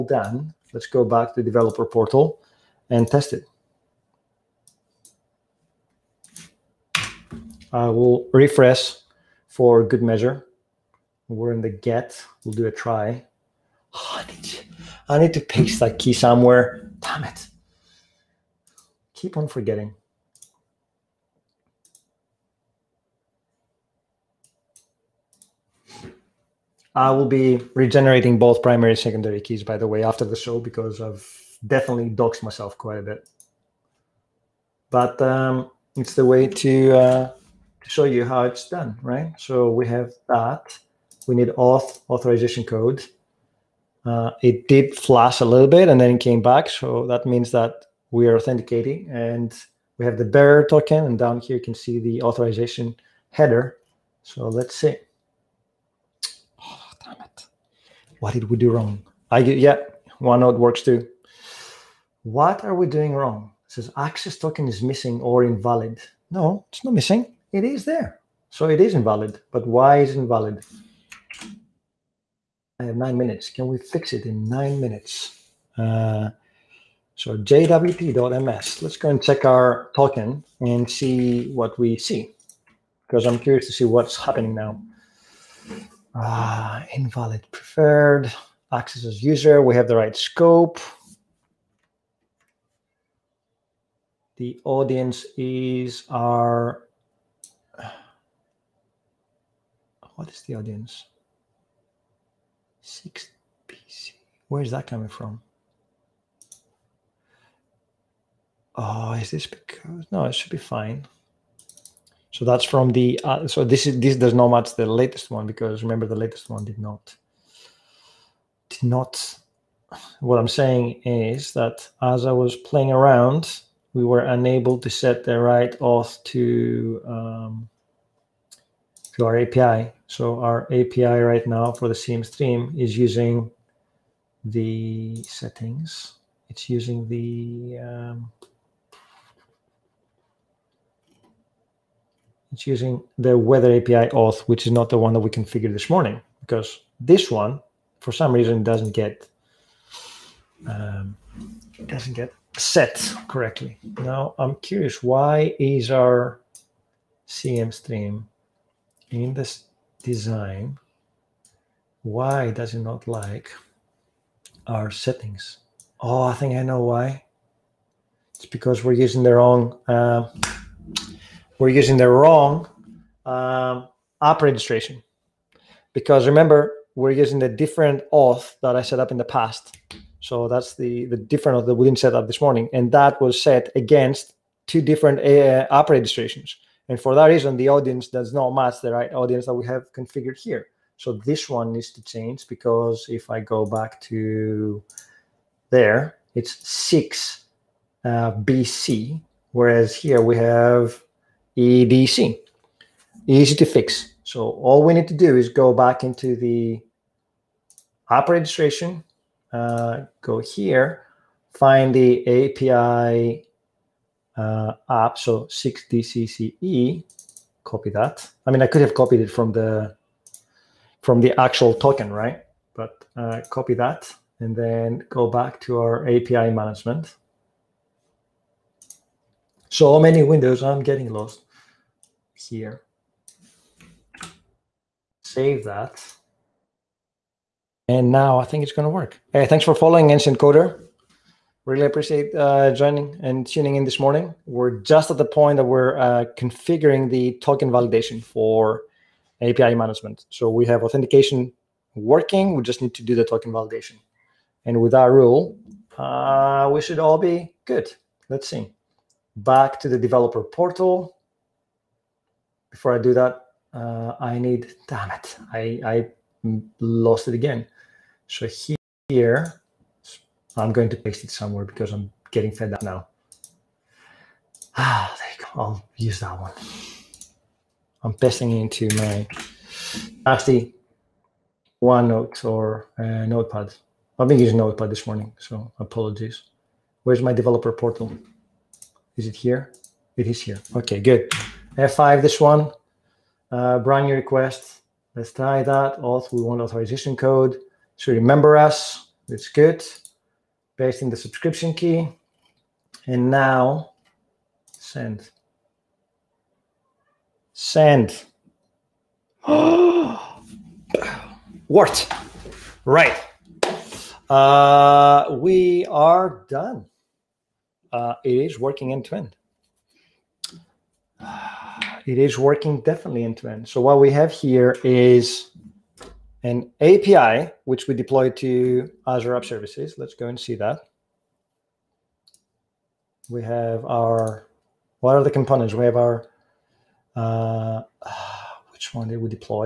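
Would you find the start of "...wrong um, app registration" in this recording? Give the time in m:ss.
2:52.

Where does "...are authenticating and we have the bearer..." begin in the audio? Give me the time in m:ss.
0:48.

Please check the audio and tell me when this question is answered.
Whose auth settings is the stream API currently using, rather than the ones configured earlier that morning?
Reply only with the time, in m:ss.
2:23.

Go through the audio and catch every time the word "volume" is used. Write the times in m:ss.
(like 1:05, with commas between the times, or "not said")
not said.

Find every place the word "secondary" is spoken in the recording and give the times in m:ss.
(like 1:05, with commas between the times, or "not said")
0:28.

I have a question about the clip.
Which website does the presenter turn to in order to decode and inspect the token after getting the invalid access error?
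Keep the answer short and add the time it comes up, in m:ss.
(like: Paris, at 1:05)
jwt.ms, at 1:17.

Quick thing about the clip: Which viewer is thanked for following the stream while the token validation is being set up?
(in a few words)
Ancient Coder.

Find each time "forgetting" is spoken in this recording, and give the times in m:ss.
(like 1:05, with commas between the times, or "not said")
0:19.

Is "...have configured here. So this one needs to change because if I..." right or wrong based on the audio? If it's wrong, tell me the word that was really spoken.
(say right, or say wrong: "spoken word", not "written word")
right.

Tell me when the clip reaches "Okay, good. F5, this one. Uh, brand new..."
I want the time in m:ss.
4:50.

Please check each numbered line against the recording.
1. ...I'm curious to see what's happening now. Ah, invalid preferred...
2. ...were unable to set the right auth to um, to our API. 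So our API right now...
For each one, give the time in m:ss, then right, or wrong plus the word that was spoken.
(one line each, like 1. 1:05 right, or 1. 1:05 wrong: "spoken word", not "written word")
1. 1:23 right
2. 2:04 right.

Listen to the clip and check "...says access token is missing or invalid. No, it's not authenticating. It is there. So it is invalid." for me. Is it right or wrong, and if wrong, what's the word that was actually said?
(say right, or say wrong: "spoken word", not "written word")
wrong: "missing", not "authenticating".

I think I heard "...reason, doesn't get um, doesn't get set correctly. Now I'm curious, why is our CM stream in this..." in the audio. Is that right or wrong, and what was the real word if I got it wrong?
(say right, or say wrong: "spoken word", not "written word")
right.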